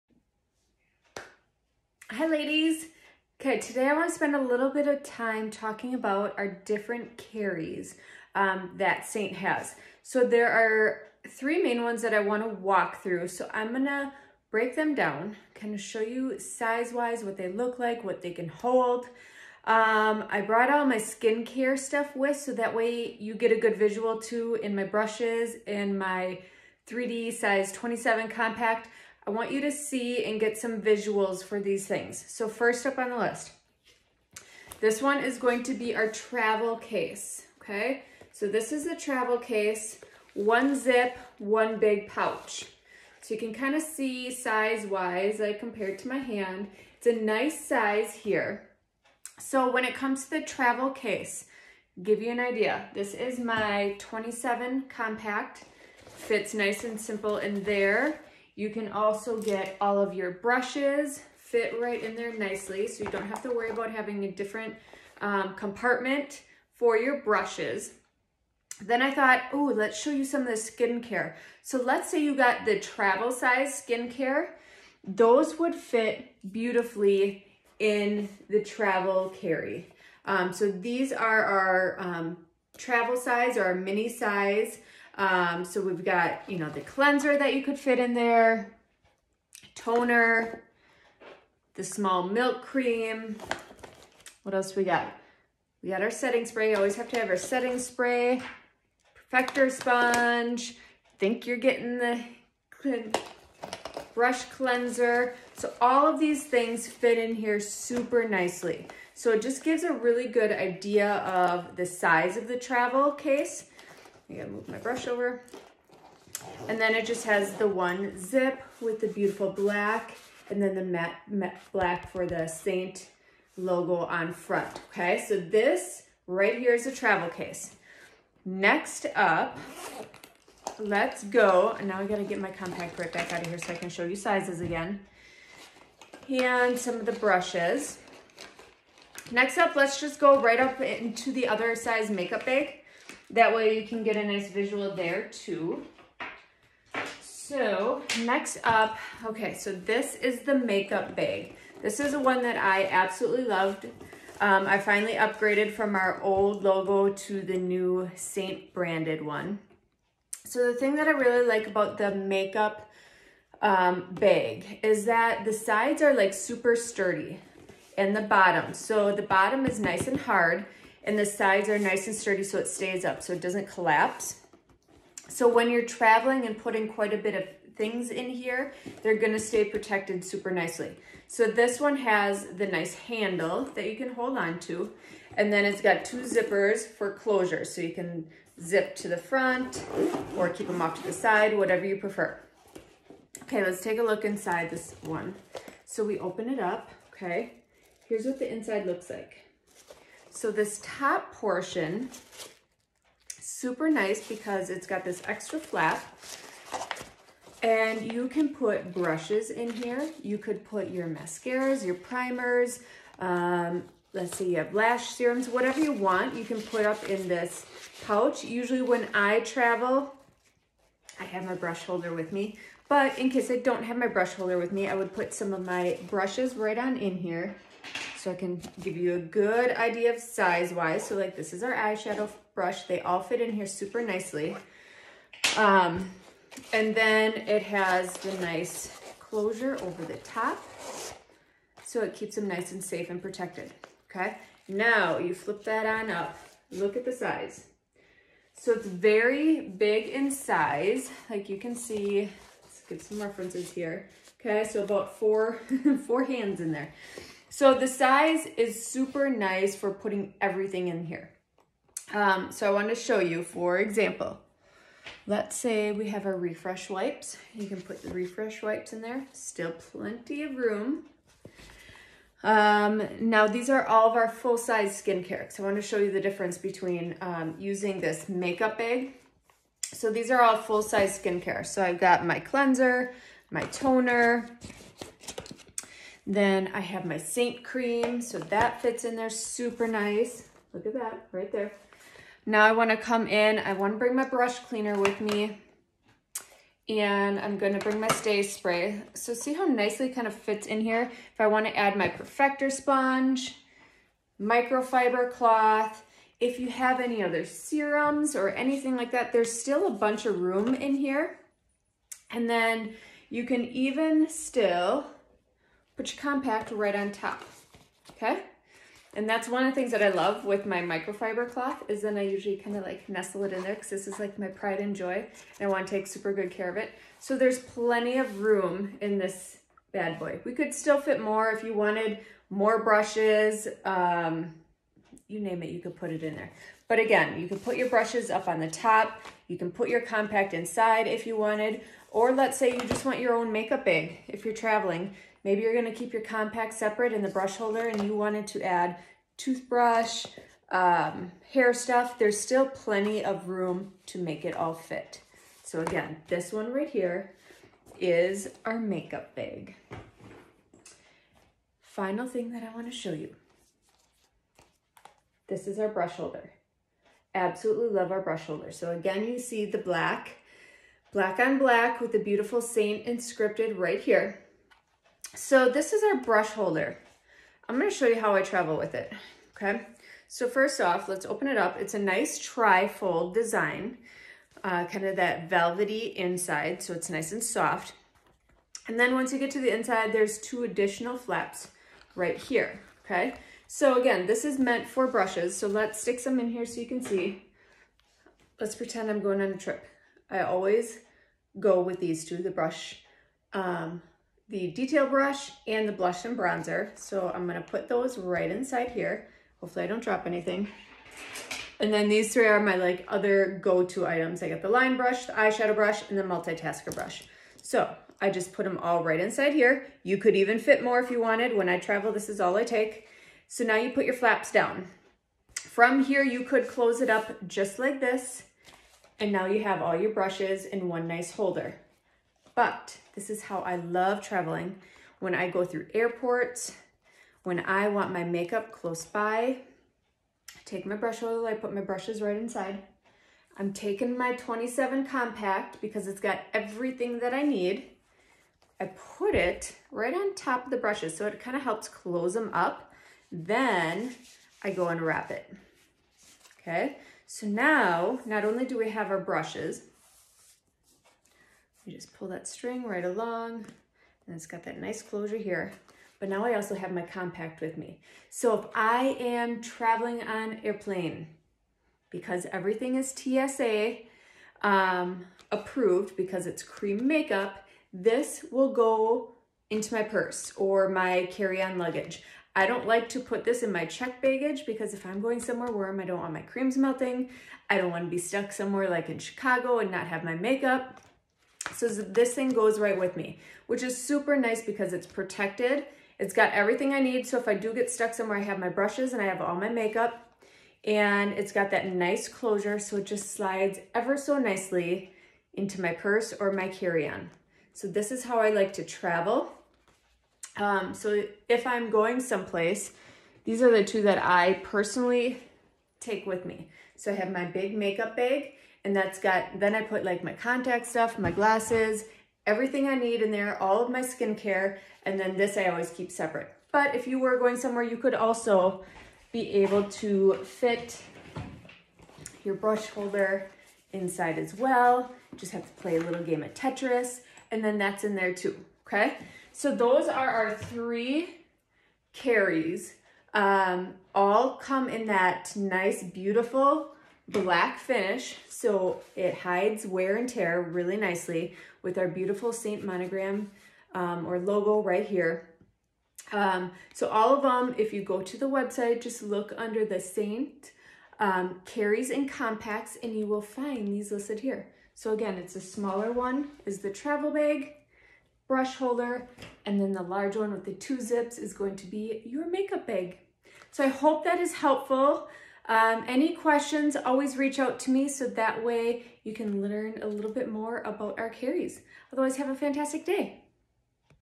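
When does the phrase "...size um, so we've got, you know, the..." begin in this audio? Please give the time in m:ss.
1:24.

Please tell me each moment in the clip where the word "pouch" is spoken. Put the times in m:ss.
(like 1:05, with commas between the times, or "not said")
0:42, 3:38.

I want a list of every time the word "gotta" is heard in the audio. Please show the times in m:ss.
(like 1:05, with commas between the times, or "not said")
1:54, 2:12.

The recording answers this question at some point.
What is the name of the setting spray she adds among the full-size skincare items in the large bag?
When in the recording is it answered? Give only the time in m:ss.
4:58.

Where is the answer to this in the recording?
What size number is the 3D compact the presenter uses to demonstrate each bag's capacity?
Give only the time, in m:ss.
0:27.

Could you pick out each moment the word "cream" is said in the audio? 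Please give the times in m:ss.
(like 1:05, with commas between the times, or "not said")
1:32, 4:47, 7:56, 8:06.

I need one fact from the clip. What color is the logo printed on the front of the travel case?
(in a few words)
Matte black.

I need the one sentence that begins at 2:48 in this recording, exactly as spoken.
So the bottom is nice and hard and the sides are nice and sturdy so it stays up so it doesn't collapse.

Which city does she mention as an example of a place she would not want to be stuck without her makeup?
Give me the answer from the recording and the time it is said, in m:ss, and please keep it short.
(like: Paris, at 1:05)
Chicago, at 8:09.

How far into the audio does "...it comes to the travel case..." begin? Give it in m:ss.
0:49.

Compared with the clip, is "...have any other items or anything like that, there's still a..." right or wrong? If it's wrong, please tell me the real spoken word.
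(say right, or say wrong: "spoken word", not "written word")
wrong: "serums", not "items".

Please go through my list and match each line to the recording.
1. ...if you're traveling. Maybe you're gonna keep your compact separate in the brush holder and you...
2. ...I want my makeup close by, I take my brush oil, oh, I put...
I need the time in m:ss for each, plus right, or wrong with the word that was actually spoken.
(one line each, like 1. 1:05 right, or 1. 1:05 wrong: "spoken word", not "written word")
1. 5:44 right
2. 7:17 right.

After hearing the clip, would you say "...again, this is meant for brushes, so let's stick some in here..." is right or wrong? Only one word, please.
right.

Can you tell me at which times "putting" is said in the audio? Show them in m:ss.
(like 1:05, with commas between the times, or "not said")
2:56, 4:19.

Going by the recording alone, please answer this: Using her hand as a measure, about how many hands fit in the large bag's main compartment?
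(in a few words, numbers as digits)
4.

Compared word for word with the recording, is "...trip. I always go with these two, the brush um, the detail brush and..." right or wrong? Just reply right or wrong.
right.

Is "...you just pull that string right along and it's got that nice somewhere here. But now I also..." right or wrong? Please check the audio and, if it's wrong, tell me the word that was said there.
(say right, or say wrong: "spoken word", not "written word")
wrong: "closure", not "somewhere".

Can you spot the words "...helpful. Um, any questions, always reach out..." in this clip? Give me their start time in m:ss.
9:34.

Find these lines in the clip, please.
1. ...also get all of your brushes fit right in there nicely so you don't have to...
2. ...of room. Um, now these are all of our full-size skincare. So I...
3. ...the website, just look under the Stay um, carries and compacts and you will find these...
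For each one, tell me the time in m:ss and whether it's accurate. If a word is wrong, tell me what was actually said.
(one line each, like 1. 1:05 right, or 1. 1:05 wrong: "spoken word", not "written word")
1. 0:58 right
2. 4:30 right
3. 9:18 wrong: "SEINT", not "Stay".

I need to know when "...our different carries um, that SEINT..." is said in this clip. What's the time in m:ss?
0:06.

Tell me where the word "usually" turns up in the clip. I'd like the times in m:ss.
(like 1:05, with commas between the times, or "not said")
3:38, 5:22.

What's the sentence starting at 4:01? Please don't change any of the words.
So it keeps them nice and safe and protected, okay?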